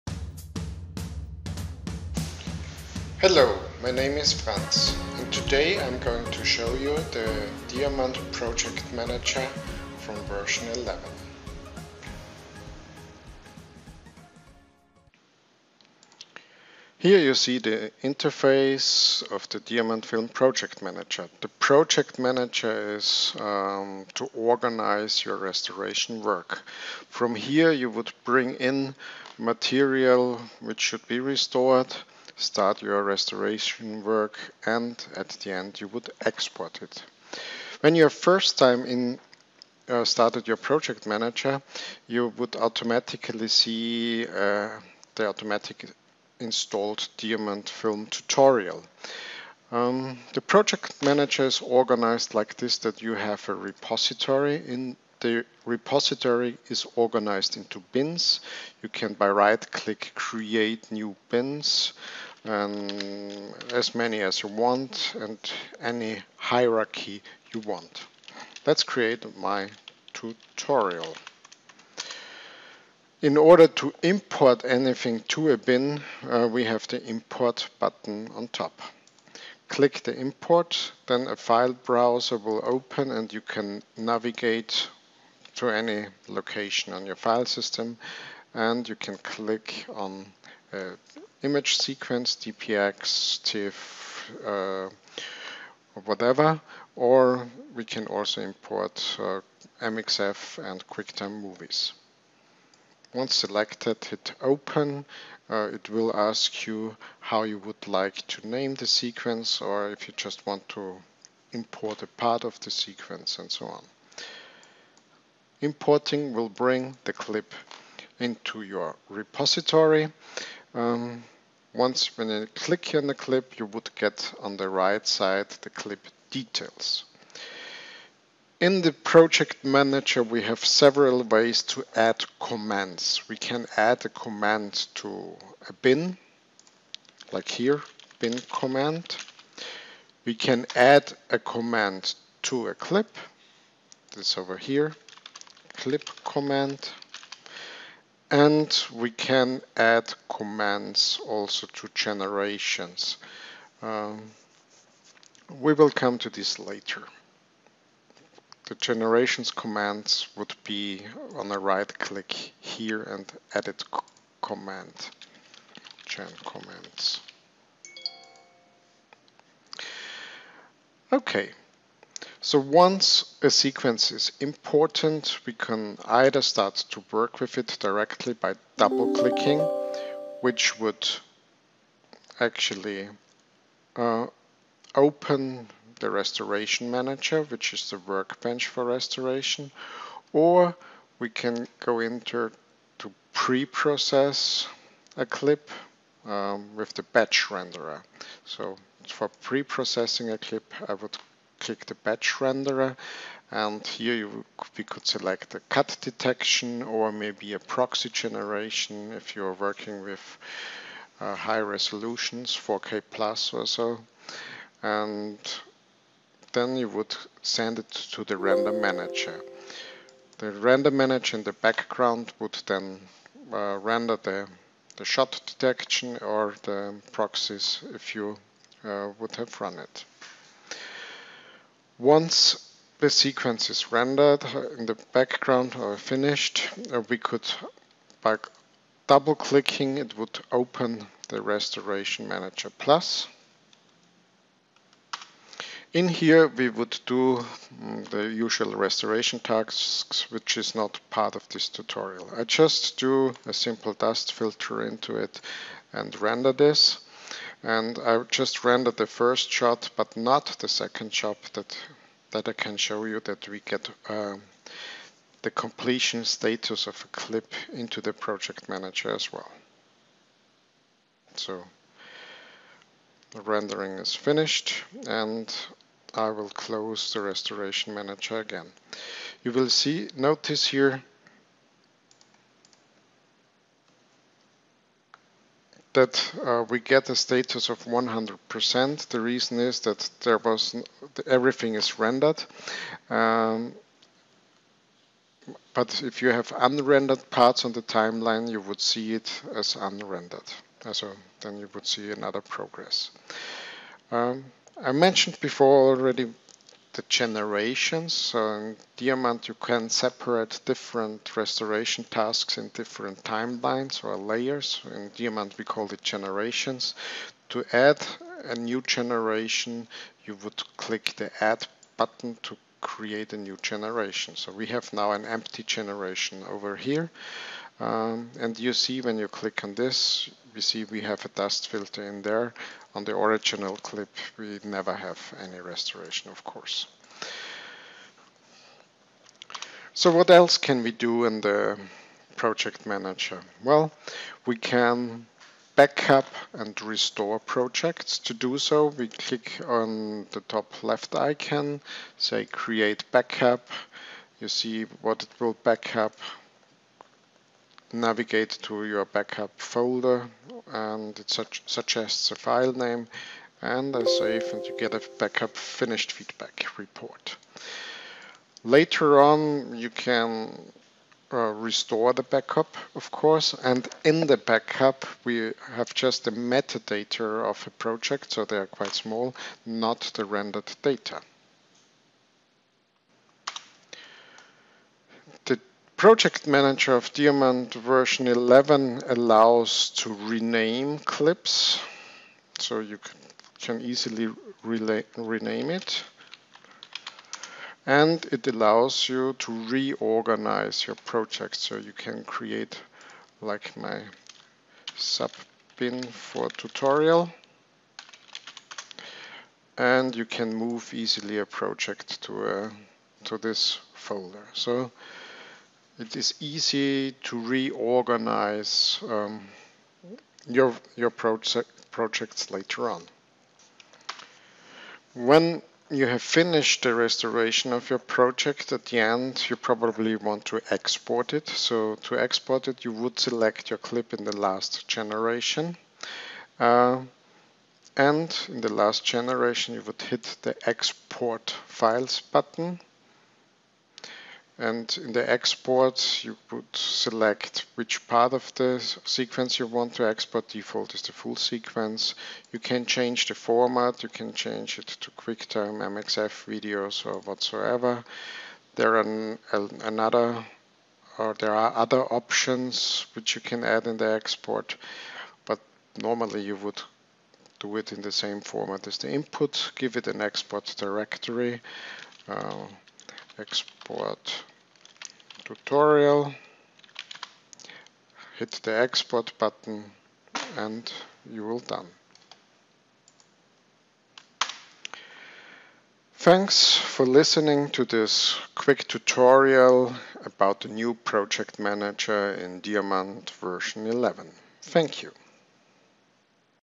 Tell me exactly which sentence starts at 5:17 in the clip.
To add a new generation, you would click the Add button to create a new generation.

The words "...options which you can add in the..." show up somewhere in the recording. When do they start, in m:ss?
7:42.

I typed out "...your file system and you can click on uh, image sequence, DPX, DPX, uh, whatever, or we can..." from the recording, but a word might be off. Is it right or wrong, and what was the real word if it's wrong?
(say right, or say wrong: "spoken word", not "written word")
wrong: "TIFF", not "DPX".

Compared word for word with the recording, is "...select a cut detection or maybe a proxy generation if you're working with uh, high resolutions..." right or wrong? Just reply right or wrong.
right.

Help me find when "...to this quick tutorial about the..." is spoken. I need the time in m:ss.
8:07.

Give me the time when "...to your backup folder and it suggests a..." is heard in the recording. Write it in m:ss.
5:58.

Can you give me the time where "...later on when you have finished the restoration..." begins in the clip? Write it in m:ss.
7:02.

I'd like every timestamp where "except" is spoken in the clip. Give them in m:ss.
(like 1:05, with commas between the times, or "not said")
not said.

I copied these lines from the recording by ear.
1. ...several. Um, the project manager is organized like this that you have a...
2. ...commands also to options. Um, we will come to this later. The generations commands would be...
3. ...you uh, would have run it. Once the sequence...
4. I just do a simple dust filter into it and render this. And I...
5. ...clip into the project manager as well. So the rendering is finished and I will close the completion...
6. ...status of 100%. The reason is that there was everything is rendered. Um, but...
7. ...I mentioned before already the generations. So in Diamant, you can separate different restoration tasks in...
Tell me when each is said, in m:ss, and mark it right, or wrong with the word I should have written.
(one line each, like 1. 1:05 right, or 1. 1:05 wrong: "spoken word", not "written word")
1. 0:48 wrong: "tutorial", not "several"
2. 2:30 wrong: "generations", not "options"
3. 3:48 right
4. 4:12 right
5. 4:27 wrong: "restoration", not "completion"
6. 4:47 right
7. 5:04 right.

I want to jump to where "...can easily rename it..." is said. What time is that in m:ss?
6:33.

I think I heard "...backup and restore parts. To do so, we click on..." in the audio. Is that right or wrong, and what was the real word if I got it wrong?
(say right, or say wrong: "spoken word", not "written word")
wrong: "projects", not "parts".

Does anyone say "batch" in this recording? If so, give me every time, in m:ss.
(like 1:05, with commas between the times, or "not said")
3:17, 3:21.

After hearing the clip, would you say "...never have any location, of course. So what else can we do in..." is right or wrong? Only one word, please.
wrong.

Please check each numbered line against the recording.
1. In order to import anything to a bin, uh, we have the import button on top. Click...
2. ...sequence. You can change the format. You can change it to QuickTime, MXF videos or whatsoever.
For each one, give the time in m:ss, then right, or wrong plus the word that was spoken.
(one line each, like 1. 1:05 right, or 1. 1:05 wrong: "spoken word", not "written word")
1. 1:13 right
2. 7:31 right.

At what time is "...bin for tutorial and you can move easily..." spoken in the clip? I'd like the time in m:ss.
6:45.